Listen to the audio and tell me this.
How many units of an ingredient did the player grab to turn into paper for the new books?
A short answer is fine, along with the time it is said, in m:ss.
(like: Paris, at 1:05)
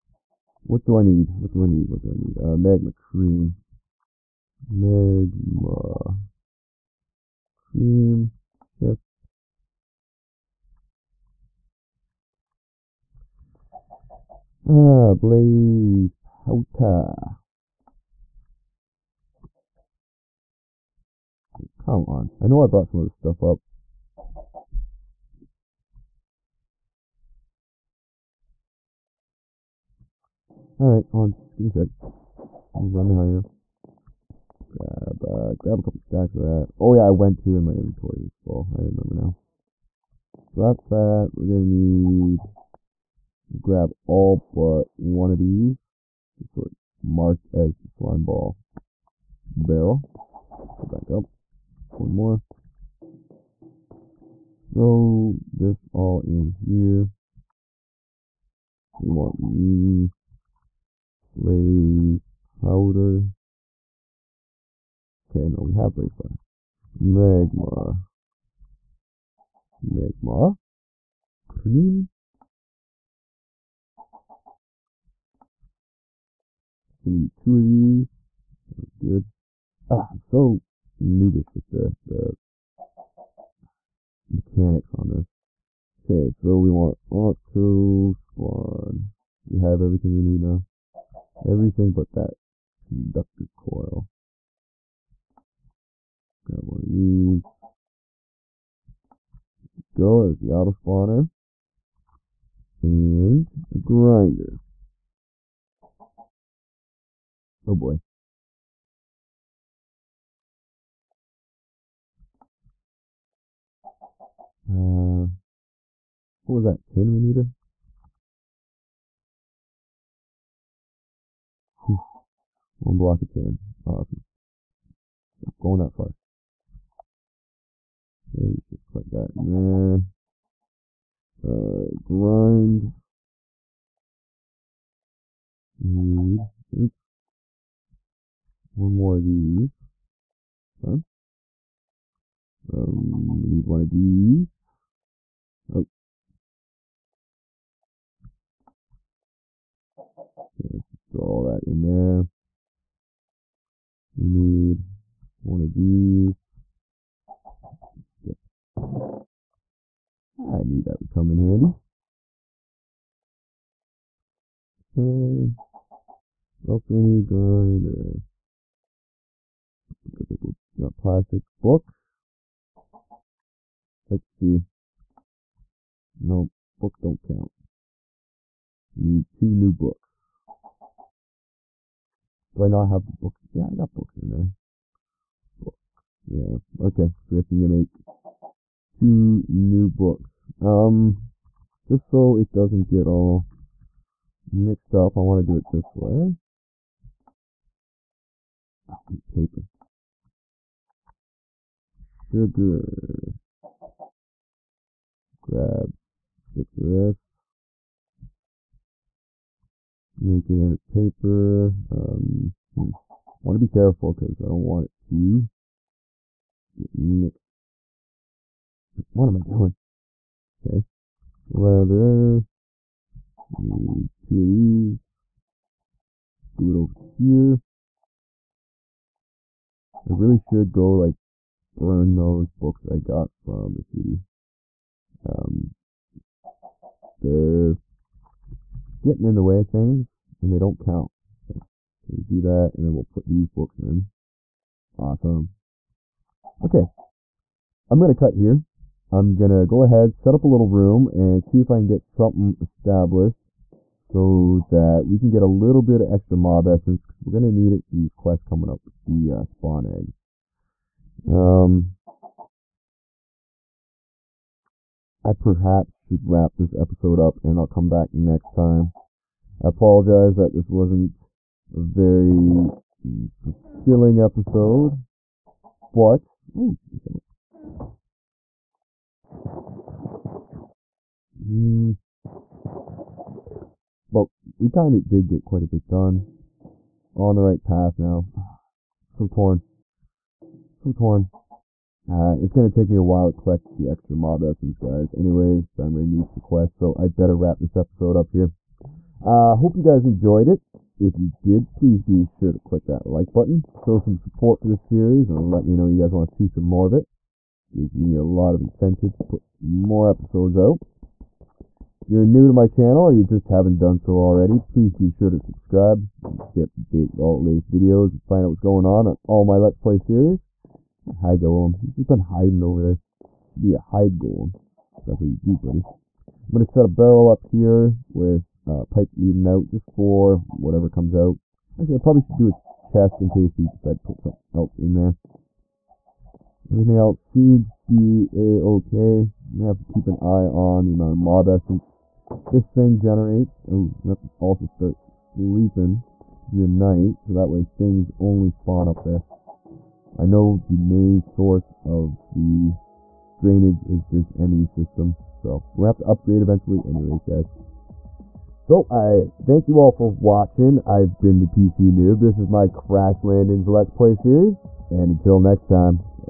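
6, at 3:26.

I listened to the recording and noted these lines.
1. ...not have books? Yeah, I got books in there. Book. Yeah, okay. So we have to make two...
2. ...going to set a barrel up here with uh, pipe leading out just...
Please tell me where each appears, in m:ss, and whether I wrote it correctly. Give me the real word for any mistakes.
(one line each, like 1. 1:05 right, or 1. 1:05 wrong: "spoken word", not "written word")
1. 3:02 right
2. 5:26 right.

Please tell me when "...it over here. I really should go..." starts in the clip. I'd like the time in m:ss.
3:46.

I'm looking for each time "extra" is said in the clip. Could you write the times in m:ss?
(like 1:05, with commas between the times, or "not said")
4:16, 4:53.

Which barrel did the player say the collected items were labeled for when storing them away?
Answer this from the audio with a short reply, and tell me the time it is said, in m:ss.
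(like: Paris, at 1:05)
slime ball barrel, at 0:47.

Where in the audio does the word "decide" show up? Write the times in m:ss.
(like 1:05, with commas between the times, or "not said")
5:33.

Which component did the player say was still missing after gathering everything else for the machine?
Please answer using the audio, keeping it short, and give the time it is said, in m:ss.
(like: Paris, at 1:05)
conductor coil, at 1:32.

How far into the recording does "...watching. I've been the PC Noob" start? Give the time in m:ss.
6:00.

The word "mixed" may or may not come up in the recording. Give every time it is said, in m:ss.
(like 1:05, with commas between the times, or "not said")
3:14, 3:36.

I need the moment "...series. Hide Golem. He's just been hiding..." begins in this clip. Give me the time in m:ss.
5:19.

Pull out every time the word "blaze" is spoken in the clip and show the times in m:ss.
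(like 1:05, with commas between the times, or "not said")
0:15, 1:01, 1:05.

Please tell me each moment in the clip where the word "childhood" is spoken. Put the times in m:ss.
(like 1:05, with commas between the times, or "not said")
not said.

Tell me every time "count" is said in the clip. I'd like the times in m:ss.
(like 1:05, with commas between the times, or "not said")
2:57, 4:00.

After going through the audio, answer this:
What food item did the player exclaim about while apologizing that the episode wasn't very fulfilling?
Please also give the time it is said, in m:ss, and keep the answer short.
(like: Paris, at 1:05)
chicken sandwich, at 4:36.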